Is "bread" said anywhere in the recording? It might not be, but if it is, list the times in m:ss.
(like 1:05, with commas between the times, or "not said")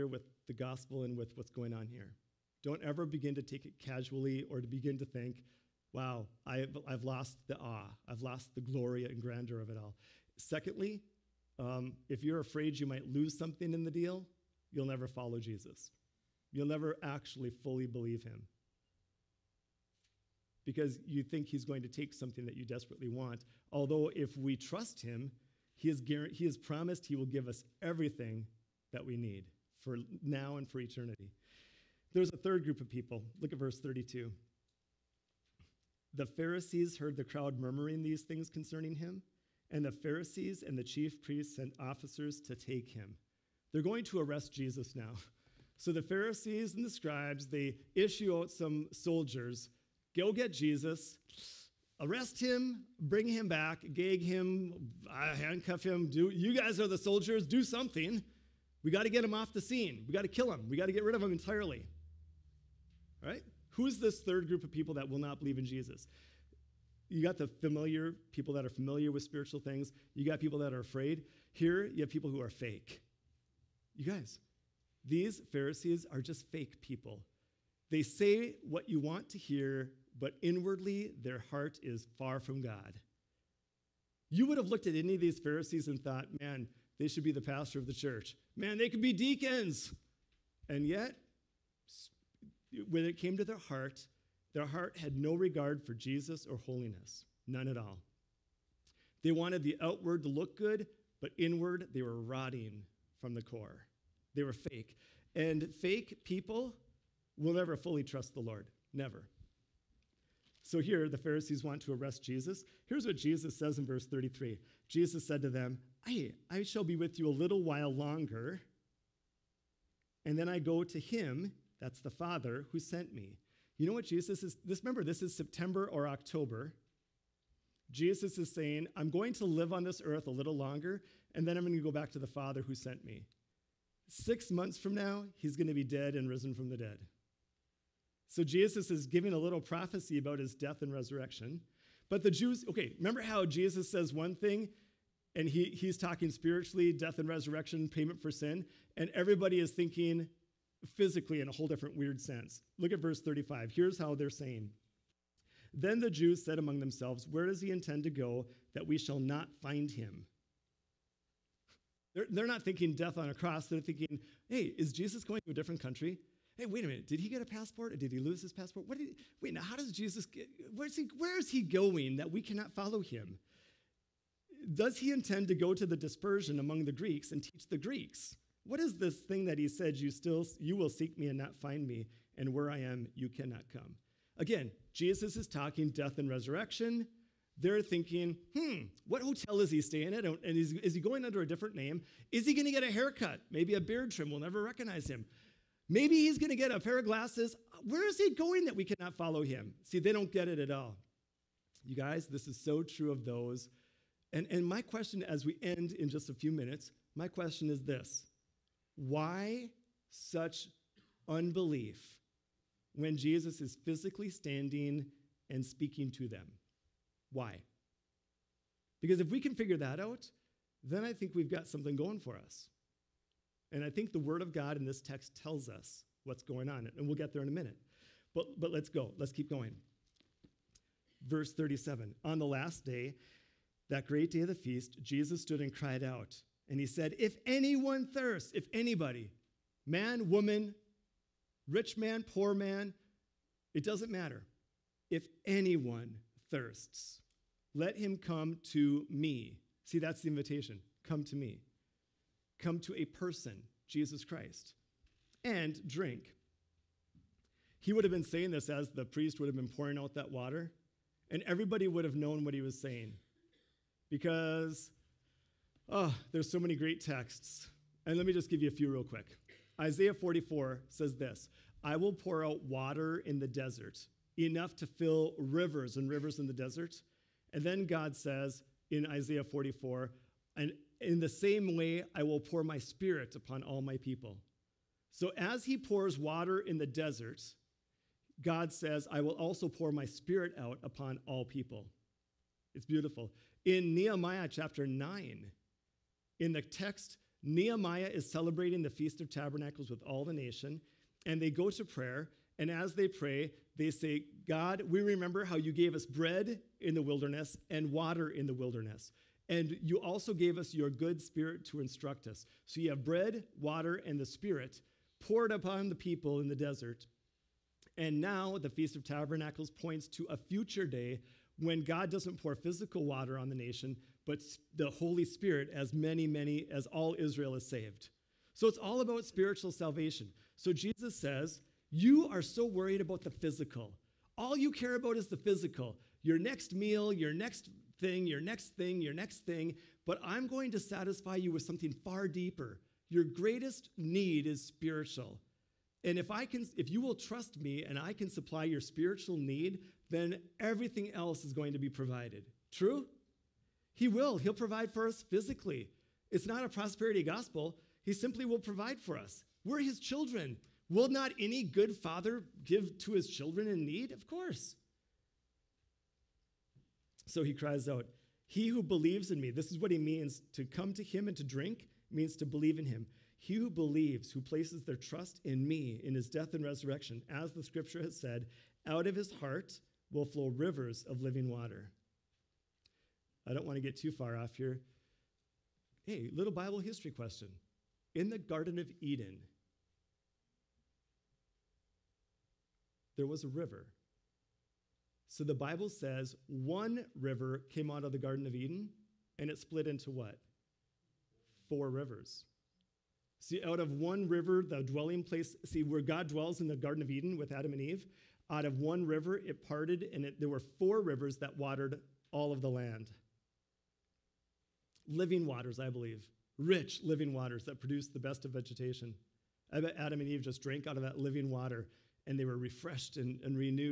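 5:06, 5:13.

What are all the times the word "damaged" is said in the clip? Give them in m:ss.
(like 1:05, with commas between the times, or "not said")
not said.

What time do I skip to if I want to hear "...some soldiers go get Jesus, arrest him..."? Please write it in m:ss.
0:48.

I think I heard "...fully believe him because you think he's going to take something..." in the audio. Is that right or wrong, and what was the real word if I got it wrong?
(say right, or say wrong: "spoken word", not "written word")
right.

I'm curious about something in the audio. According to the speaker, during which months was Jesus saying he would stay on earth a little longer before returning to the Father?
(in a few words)
September or October.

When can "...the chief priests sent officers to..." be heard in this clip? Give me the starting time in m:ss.
0:40.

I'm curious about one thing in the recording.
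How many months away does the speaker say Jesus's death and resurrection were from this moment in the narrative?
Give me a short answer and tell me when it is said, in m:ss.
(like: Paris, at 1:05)
6, at 2:14.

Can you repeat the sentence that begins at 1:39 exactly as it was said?
They wanted the outward to look good, but inward they were rotting from the core.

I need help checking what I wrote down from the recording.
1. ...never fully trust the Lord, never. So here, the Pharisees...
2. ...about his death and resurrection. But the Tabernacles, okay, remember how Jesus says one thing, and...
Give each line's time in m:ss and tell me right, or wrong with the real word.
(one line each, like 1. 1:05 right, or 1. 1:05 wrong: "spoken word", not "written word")
1. 1:47 right
2. 2:20 wrong: "Jews", not "Tabernacles".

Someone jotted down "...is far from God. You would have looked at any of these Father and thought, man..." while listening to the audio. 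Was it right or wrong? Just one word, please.
wrong.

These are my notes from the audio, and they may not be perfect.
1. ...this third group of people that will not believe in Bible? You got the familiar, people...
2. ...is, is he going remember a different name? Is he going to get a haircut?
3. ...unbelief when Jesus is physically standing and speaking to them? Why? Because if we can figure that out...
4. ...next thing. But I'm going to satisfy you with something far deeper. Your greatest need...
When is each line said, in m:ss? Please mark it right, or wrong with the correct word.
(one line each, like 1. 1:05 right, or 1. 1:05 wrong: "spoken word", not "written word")
1. 1:03 wrong: "Jesus", not "Bible"
2. 3:10 wrong: "under", not "remember"
3. 3:31 right
4. 5:39 right.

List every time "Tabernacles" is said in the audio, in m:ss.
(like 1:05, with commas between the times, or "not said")
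4:59, 5:19.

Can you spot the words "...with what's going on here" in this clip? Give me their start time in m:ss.
0:01.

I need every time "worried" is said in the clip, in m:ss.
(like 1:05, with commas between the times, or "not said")
5:32.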